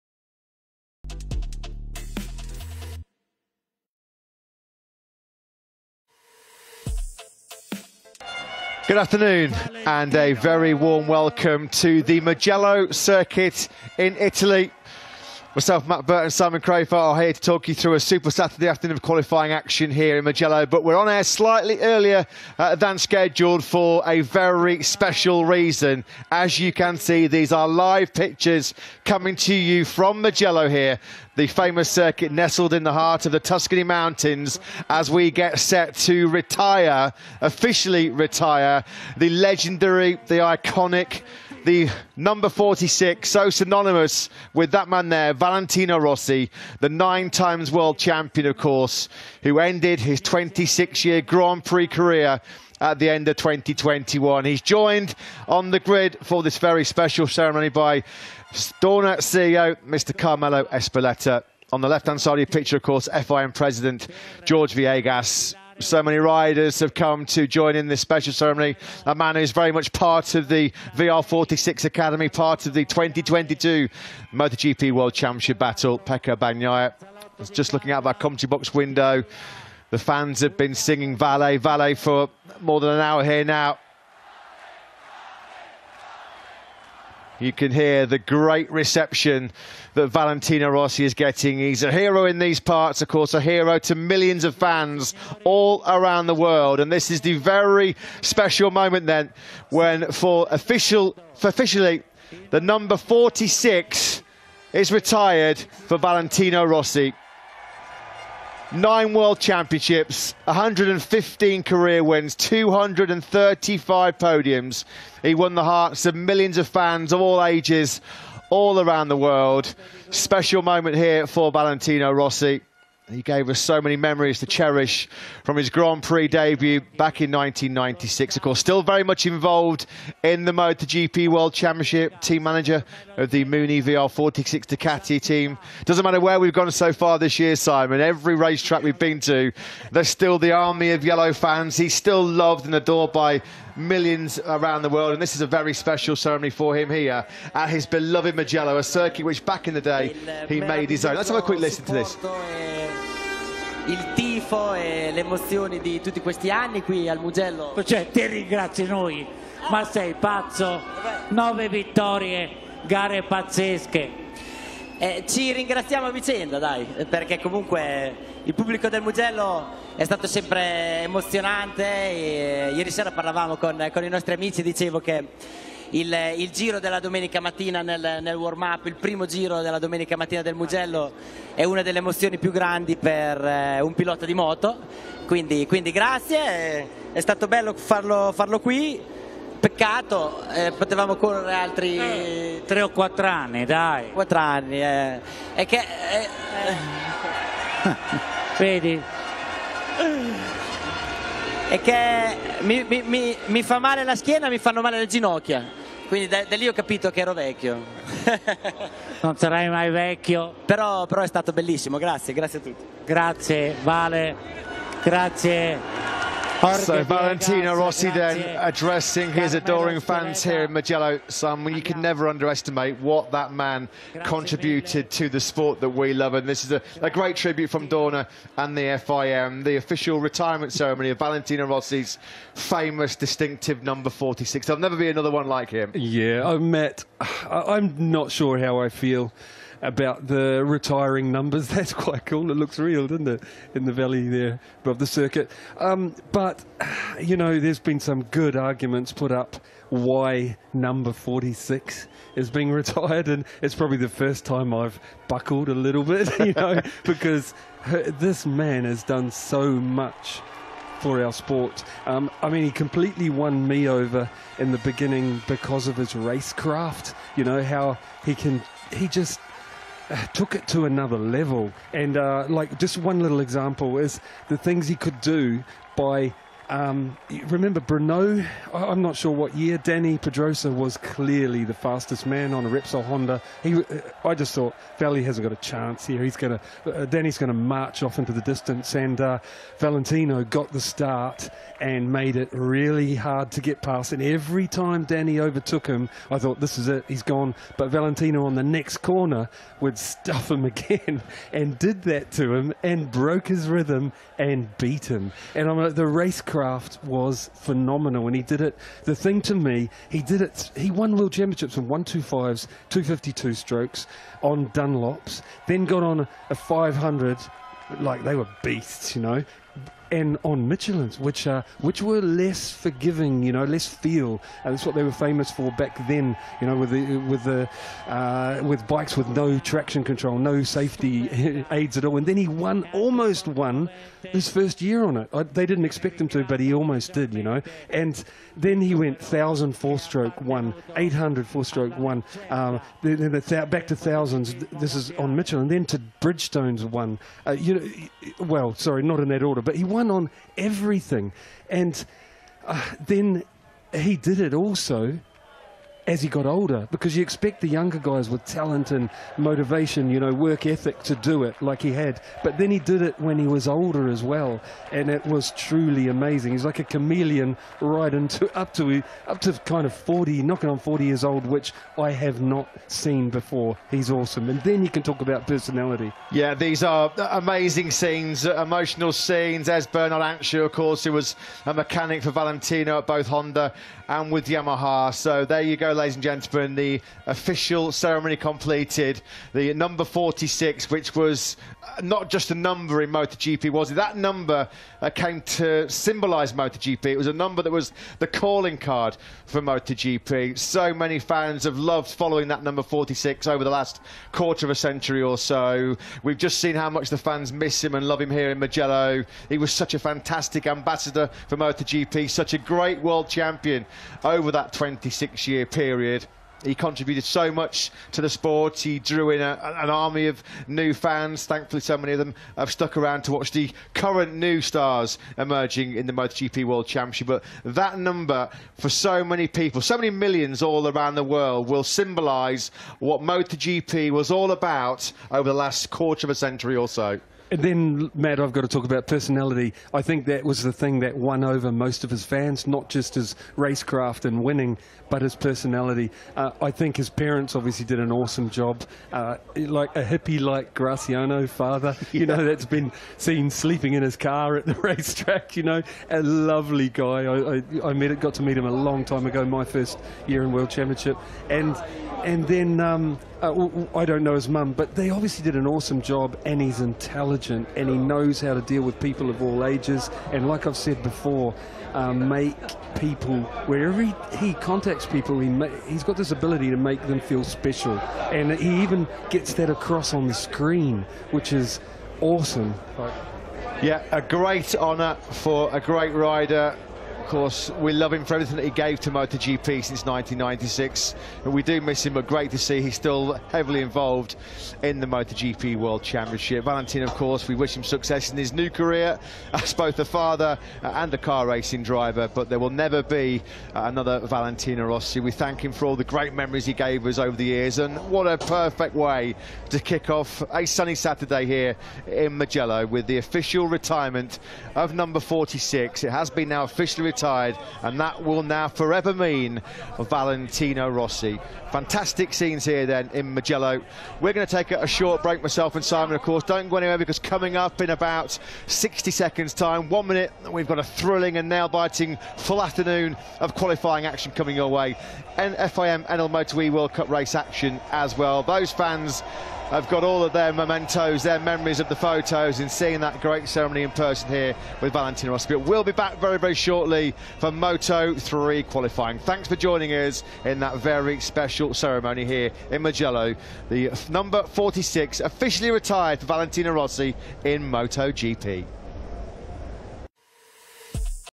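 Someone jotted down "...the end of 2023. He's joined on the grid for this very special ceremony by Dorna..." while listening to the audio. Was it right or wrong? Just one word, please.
wrong.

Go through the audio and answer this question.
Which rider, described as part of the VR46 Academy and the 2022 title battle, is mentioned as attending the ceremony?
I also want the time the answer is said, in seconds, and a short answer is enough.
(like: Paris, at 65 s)
Pecco Bagnaia, at 75 s.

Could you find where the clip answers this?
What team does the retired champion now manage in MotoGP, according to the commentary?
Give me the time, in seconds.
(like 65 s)
133 s.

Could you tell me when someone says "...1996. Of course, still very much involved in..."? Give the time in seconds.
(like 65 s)
127 s.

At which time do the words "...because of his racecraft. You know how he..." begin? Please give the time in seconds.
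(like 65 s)
265 s.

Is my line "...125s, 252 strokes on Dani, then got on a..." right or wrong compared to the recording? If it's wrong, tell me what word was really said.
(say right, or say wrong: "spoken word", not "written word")
wrong: "Dunlops", not "Dani".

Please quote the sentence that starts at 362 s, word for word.
But then he did it when he was older as well, and it was truly amazing.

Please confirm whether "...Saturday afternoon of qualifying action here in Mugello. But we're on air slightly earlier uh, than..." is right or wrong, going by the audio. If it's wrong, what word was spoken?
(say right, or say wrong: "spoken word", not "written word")
right.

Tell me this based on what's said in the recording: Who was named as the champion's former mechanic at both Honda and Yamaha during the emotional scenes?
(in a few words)
Bernard Ansiau.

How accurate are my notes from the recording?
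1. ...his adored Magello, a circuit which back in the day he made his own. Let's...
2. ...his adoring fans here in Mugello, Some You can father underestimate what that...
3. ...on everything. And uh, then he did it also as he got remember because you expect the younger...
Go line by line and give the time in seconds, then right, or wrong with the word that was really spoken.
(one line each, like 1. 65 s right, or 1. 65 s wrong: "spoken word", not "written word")
1. 147 s wrong: "beloved", not "adored"
2. 219 s wrong: "never", not "father"
3. 350 s wrong: "older", not "remember".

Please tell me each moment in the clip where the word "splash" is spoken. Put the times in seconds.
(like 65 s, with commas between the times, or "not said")
not said.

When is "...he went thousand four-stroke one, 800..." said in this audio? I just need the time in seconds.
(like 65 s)
338 s.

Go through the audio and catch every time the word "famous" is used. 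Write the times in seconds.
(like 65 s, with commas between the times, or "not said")
31 s, 232 s, 325 s.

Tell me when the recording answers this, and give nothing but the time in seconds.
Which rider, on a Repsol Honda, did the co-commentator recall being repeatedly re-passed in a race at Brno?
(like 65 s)
279 s.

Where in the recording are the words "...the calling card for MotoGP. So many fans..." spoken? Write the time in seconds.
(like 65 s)
398 s.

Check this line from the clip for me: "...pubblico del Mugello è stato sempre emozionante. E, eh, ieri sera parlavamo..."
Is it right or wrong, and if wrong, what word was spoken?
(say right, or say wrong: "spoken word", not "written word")
right.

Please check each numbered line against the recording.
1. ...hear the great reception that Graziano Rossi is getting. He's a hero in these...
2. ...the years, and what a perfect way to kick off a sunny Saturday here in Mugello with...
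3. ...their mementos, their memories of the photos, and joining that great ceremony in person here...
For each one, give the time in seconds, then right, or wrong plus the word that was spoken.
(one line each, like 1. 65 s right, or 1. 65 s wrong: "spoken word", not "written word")
1. 87 s wrong: "Valentino", not "Graziano"
2. 507 s right
3. 540 s wrong: "seeing", not "joining".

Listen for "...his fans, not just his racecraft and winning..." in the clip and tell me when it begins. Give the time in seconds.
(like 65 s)
442 s.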